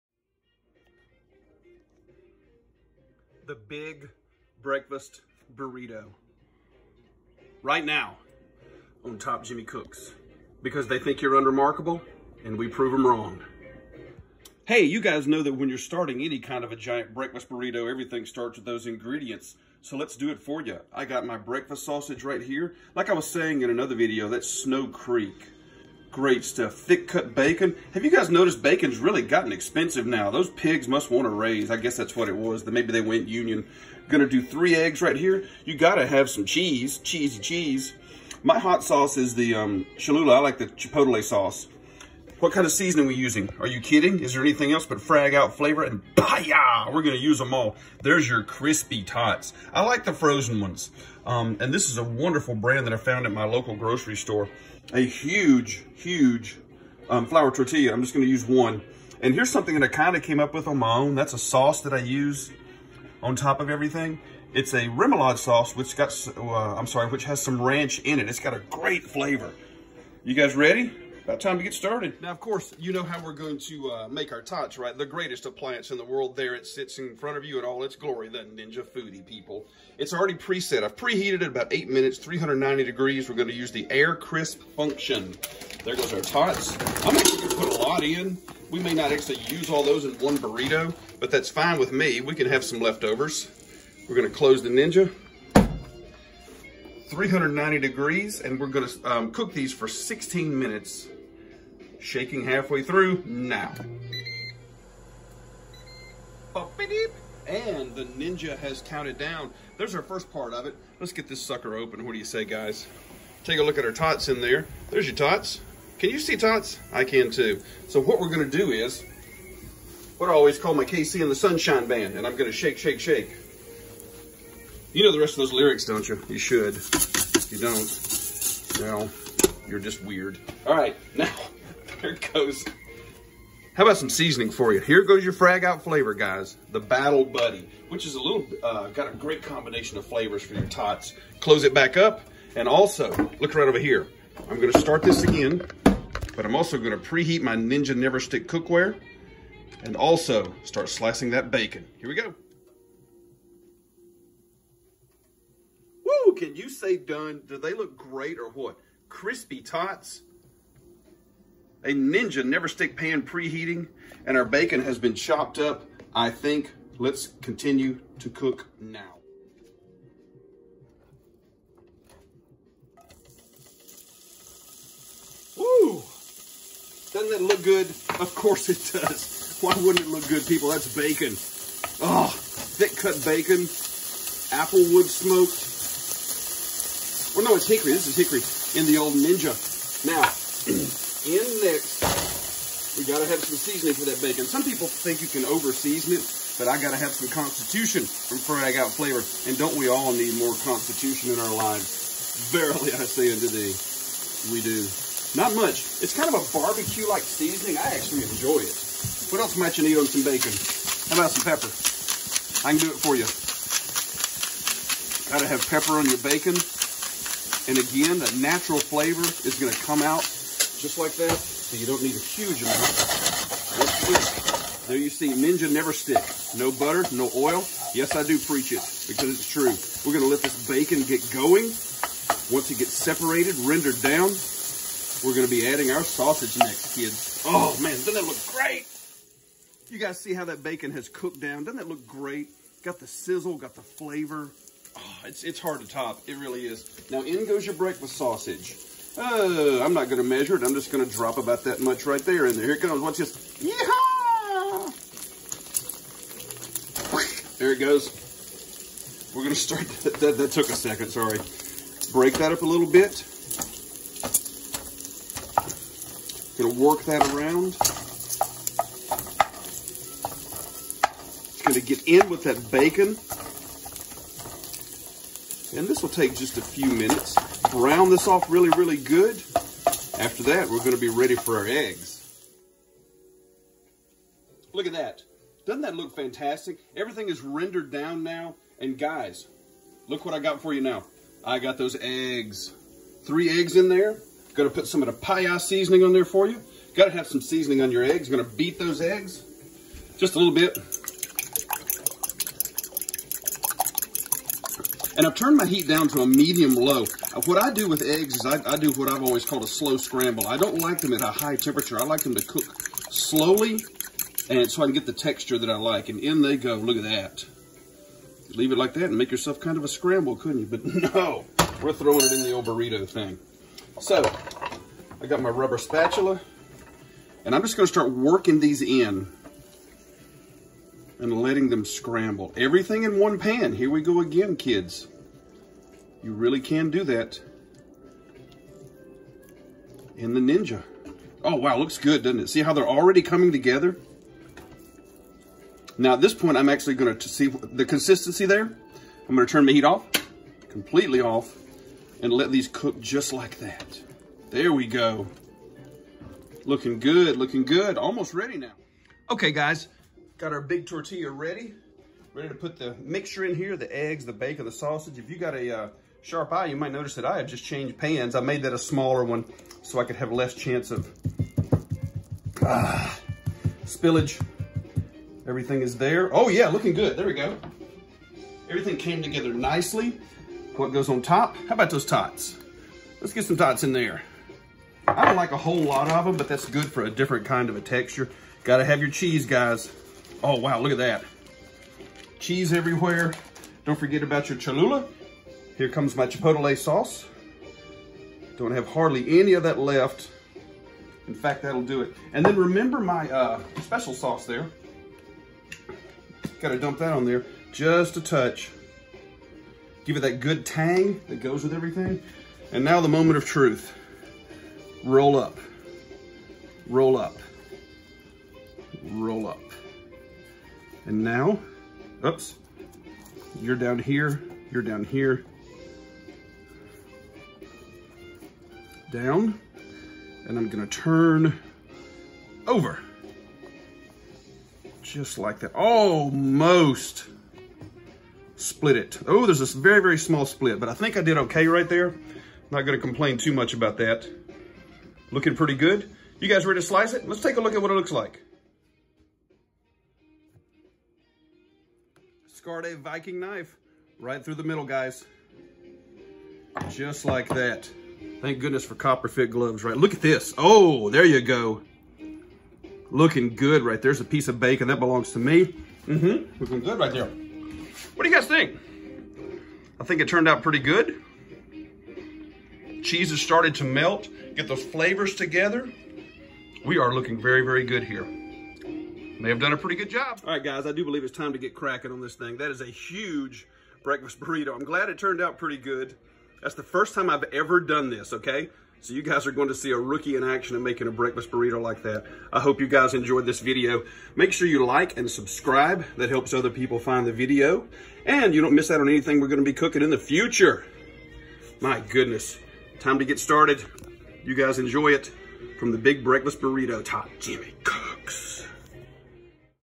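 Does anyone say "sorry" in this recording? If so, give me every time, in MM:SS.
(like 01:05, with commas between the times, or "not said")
01:06, 04:21.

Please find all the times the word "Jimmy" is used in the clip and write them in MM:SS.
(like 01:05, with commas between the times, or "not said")
00:09, 08:27.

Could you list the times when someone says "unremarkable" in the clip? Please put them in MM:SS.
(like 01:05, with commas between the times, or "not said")
00:11.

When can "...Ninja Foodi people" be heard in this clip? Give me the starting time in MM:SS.
01:18.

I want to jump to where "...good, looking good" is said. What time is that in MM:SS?
05:56.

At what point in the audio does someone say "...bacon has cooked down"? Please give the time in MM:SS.
04:00.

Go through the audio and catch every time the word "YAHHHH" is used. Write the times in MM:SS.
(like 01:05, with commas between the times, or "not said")
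00:46, 04:55.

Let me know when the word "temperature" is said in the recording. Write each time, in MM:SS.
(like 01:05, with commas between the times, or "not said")
05:11.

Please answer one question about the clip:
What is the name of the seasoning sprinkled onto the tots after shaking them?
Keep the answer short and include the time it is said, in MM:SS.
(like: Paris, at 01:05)
Battle Buddy, at 02:16.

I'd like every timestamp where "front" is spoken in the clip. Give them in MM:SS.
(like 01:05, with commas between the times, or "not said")
01:17.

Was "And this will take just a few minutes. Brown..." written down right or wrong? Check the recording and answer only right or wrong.
right.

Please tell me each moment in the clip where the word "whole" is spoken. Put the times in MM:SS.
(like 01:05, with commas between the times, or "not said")
06:25.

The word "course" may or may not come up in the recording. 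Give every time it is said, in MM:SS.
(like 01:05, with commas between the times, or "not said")
01:12, 02:58.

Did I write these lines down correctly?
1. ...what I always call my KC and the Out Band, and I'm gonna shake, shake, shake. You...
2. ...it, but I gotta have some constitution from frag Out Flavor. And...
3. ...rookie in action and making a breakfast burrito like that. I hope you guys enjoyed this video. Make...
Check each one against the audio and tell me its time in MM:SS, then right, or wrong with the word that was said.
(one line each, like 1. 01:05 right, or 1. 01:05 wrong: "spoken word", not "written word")
1. 02:00 wrong: "Sunshine", not "Out"
2. 03:16 right
3. 08:09 right.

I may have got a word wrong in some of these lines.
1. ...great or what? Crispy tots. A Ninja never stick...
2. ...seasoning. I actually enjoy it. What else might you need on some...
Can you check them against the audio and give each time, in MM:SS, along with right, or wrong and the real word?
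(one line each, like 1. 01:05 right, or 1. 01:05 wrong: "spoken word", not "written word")
1. 02:37 right
2. 03:27 right.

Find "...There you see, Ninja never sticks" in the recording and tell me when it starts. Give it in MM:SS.
03:44.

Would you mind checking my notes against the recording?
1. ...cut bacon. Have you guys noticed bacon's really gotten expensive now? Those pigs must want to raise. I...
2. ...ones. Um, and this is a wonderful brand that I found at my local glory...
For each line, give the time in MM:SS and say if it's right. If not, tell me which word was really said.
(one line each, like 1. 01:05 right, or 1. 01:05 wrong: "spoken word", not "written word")
1. 00:27 right
2. 00:50 wrong: "grocery", not "glory".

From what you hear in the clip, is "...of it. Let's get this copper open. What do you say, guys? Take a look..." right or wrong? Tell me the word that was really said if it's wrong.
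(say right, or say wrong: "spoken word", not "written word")
wrong: "sucker", not "copper".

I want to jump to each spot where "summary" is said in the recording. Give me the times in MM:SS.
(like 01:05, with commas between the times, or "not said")
not said.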